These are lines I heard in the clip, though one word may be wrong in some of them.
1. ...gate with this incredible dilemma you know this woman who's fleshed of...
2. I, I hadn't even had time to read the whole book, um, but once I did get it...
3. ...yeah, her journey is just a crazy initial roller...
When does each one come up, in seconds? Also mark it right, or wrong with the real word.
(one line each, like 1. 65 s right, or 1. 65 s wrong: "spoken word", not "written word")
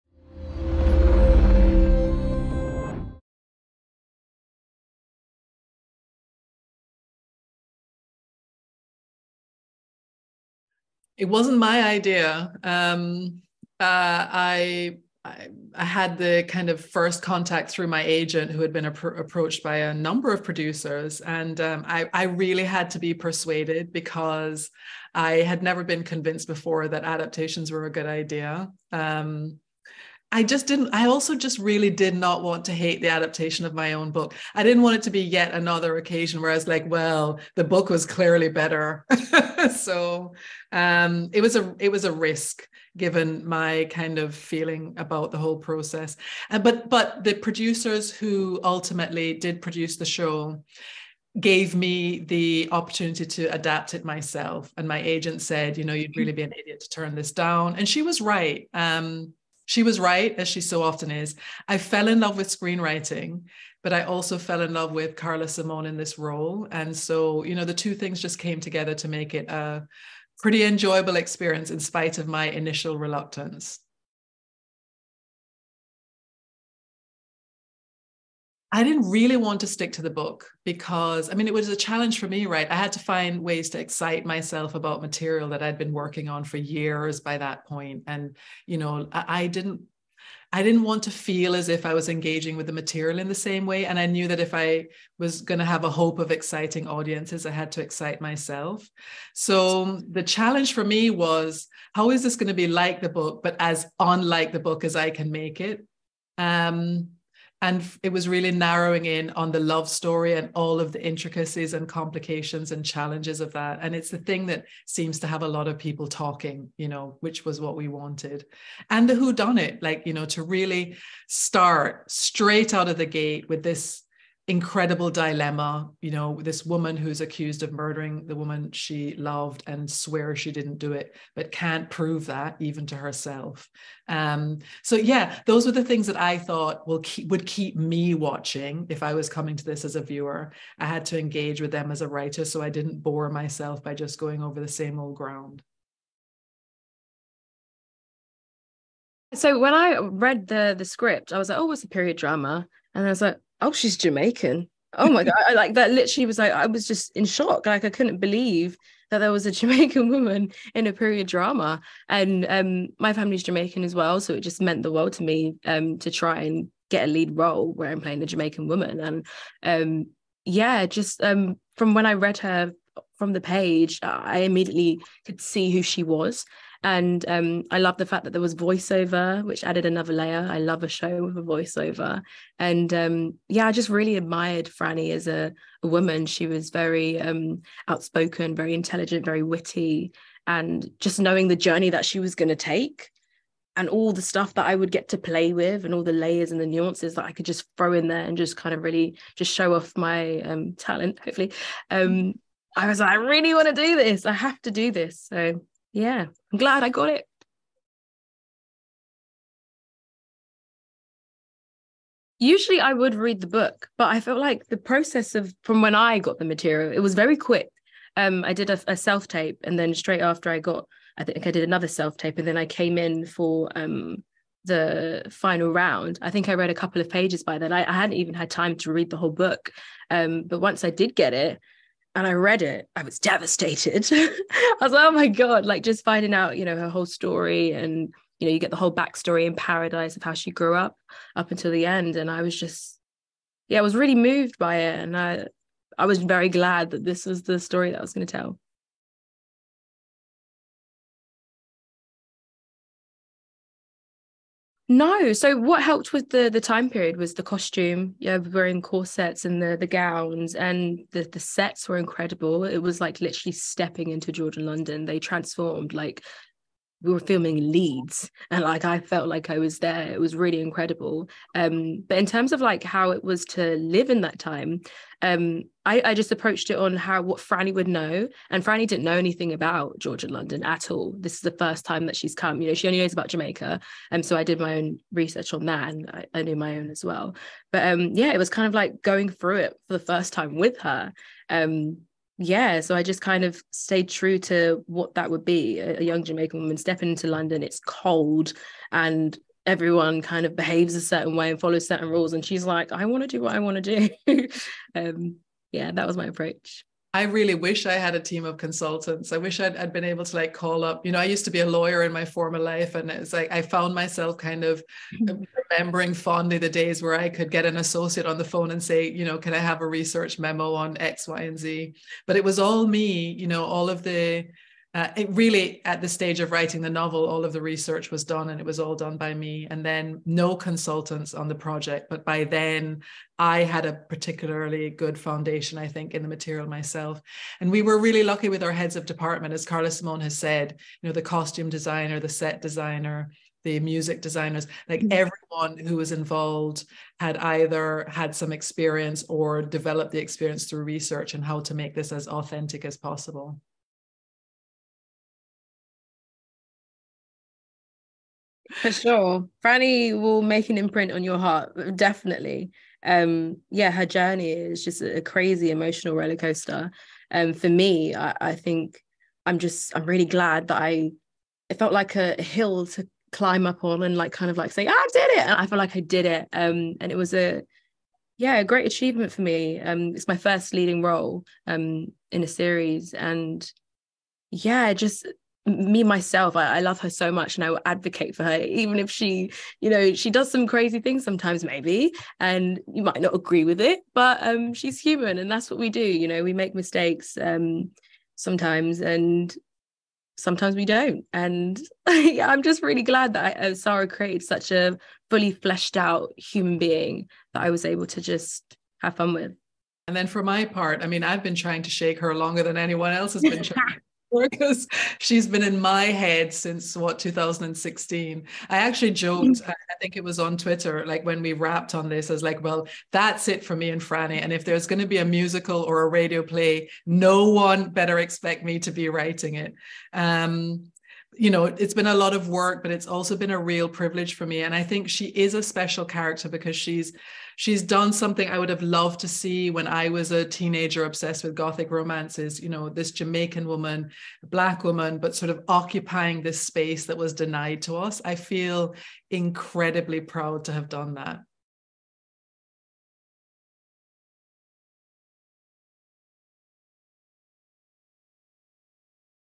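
1. 123 s wrong: "accused", not "fleshed"
2. 227 s right
3. 363 s wrong: "emotional", not "initial".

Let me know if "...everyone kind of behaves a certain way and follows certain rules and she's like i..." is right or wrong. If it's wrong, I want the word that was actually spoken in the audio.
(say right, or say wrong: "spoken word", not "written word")
right.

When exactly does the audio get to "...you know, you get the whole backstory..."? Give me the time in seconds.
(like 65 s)
238 s.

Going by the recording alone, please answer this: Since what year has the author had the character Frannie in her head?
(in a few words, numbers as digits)
2016.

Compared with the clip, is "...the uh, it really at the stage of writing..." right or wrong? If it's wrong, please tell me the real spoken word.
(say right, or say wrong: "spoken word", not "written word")
right.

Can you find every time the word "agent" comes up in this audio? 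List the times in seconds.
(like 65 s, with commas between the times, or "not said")
18 s, 55 s.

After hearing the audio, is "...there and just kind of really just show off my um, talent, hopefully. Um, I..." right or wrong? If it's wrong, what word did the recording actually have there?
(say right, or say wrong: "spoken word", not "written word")
right.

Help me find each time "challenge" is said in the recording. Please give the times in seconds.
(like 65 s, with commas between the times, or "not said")
81 s, 100 s, 112 s.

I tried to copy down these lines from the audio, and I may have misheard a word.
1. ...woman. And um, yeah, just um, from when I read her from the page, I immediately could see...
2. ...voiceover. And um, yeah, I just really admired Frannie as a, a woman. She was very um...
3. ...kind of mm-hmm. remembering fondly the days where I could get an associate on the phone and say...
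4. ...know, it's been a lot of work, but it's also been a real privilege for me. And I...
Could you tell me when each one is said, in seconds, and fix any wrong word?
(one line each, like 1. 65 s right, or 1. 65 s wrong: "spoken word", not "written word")
1. 168 s right
2. 181 s right
3. 314 s right
4. 431 s right.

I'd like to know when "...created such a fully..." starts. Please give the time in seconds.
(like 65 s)
404 s.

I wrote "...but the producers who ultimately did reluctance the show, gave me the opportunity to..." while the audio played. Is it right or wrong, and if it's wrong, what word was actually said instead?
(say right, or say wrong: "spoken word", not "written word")
wrong: "produce", not "reluctance".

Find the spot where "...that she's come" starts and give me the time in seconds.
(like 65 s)
282 s.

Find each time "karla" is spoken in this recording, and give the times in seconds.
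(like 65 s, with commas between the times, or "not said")
65 s, 339 s.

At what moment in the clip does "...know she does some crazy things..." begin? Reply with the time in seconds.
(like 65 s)
389 s.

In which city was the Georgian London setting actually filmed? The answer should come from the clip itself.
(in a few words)
Leeds.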